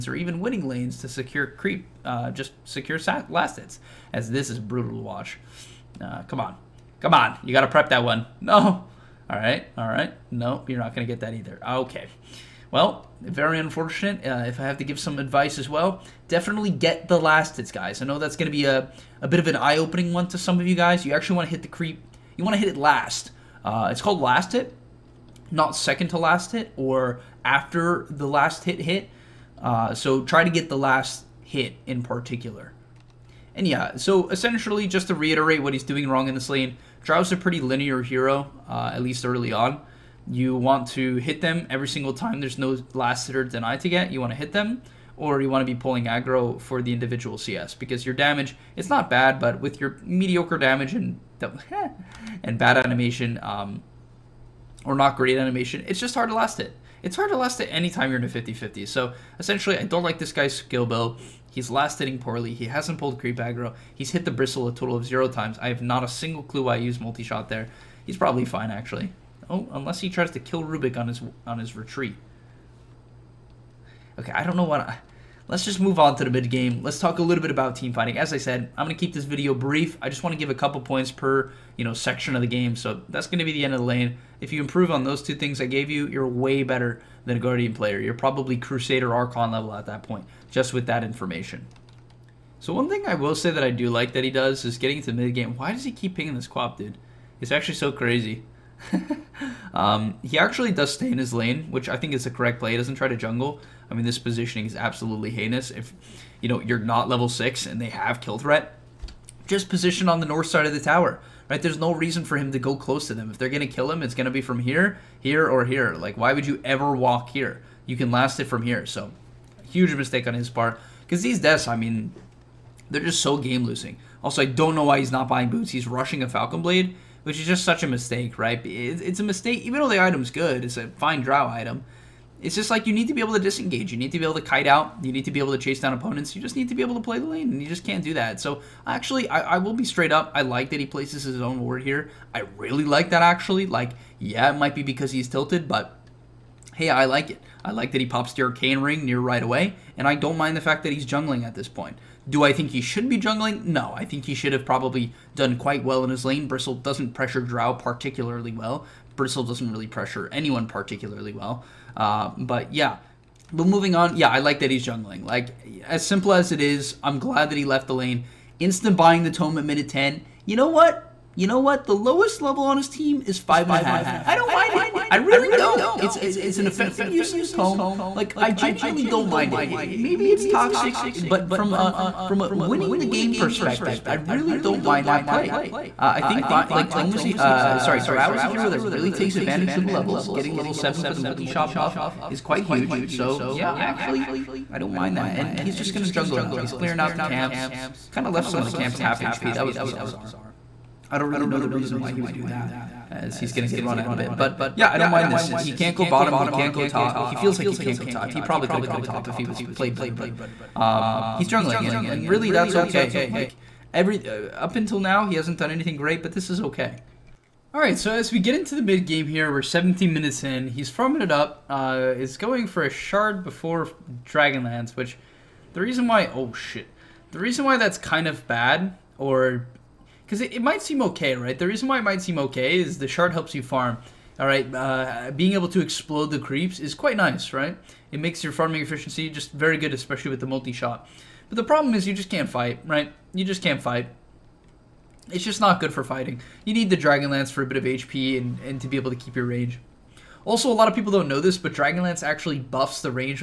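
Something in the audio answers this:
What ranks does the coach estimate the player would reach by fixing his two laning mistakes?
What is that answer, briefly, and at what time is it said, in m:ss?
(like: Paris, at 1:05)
Crusader Archon, at 1:28.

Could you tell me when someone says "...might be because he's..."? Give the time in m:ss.
2:24.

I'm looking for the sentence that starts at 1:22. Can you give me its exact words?
So that's going to be the end of the lane.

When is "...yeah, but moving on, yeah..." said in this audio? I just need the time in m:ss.
2:42.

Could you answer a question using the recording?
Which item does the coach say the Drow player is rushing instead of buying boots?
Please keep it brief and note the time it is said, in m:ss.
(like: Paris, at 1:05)
Falcon Blade, at 2:06.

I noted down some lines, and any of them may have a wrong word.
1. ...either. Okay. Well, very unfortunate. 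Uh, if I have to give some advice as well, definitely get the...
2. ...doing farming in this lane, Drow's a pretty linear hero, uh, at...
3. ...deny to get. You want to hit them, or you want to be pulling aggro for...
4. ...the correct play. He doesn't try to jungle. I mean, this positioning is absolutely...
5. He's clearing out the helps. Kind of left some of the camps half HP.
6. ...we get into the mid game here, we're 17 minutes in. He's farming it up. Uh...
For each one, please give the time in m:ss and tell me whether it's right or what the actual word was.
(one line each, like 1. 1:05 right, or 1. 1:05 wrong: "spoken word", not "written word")
1. 0:11 right
2. 0:35 wrong: "wrong", not "farming"
3. 0:43 right
4. 1:42 right
5. 3:16 wrong: "camps", not "helps"
6. 3:38 right.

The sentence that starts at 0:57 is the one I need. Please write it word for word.
It's hard to last it anytime you're in a 50-50.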